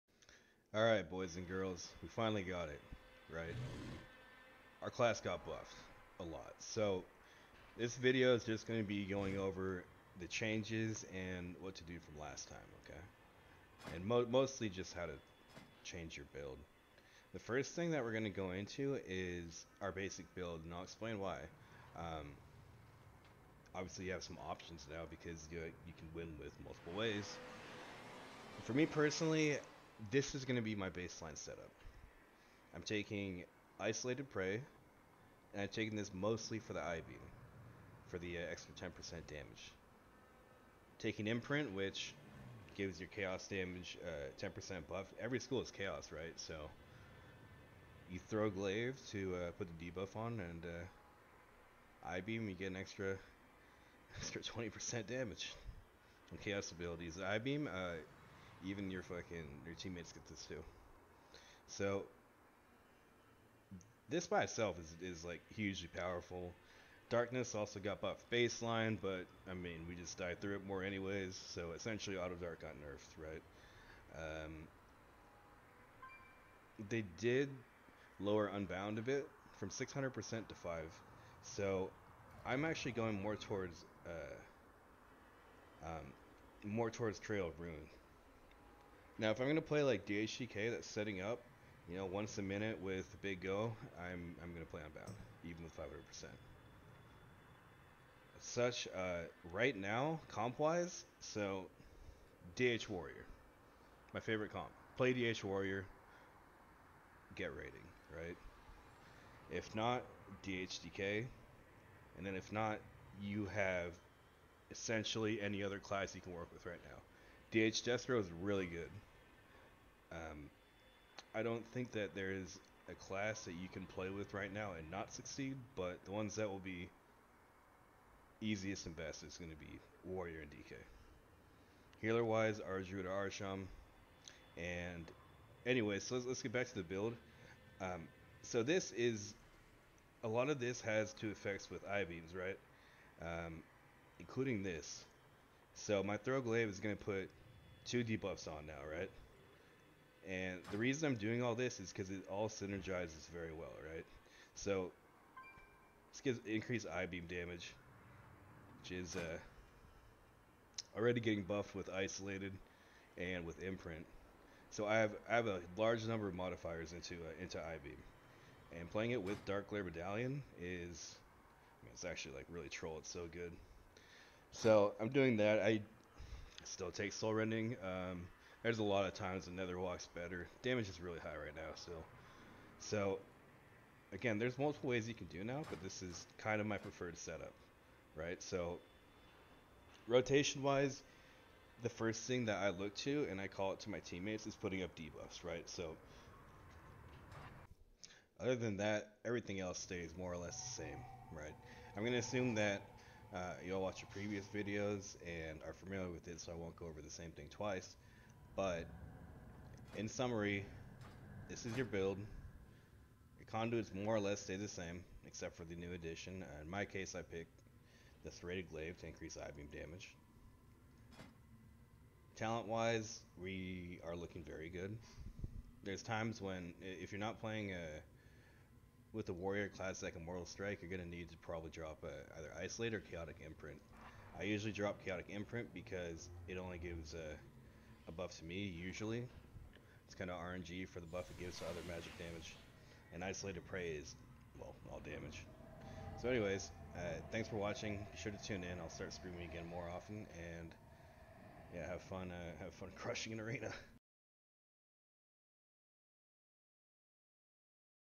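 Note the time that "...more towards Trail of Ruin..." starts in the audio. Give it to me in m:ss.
1:26.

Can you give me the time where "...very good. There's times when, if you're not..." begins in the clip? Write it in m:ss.
3:44.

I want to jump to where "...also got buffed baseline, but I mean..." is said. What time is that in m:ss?
1:07.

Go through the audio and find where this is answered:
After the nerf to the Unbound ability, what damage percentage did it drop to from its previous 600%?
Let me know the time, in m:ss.
1:35.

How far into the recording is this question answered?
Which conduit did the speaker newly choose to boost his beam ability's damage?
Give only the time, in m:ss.
3:38.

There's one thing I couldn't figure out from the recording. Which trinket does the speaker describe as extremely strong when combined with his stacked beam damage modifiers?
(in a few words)
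Darkglare Medallion.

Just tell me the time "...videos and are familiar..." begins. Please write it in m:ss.
3:24.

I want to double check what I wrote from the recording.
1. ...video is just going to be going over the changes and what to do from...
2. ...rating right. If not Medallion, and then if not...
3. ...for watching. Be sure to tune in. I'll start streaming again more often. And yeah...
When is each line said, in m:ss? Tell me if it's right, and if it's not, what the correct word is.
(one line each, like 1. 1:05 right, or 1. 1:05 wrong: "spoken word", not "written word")
1. 0:07 right
2. 1:47 wrong: "DHDK", not "Medallion"
3. 4:07 right.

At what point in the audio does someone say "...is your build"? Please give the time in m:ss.
3:31.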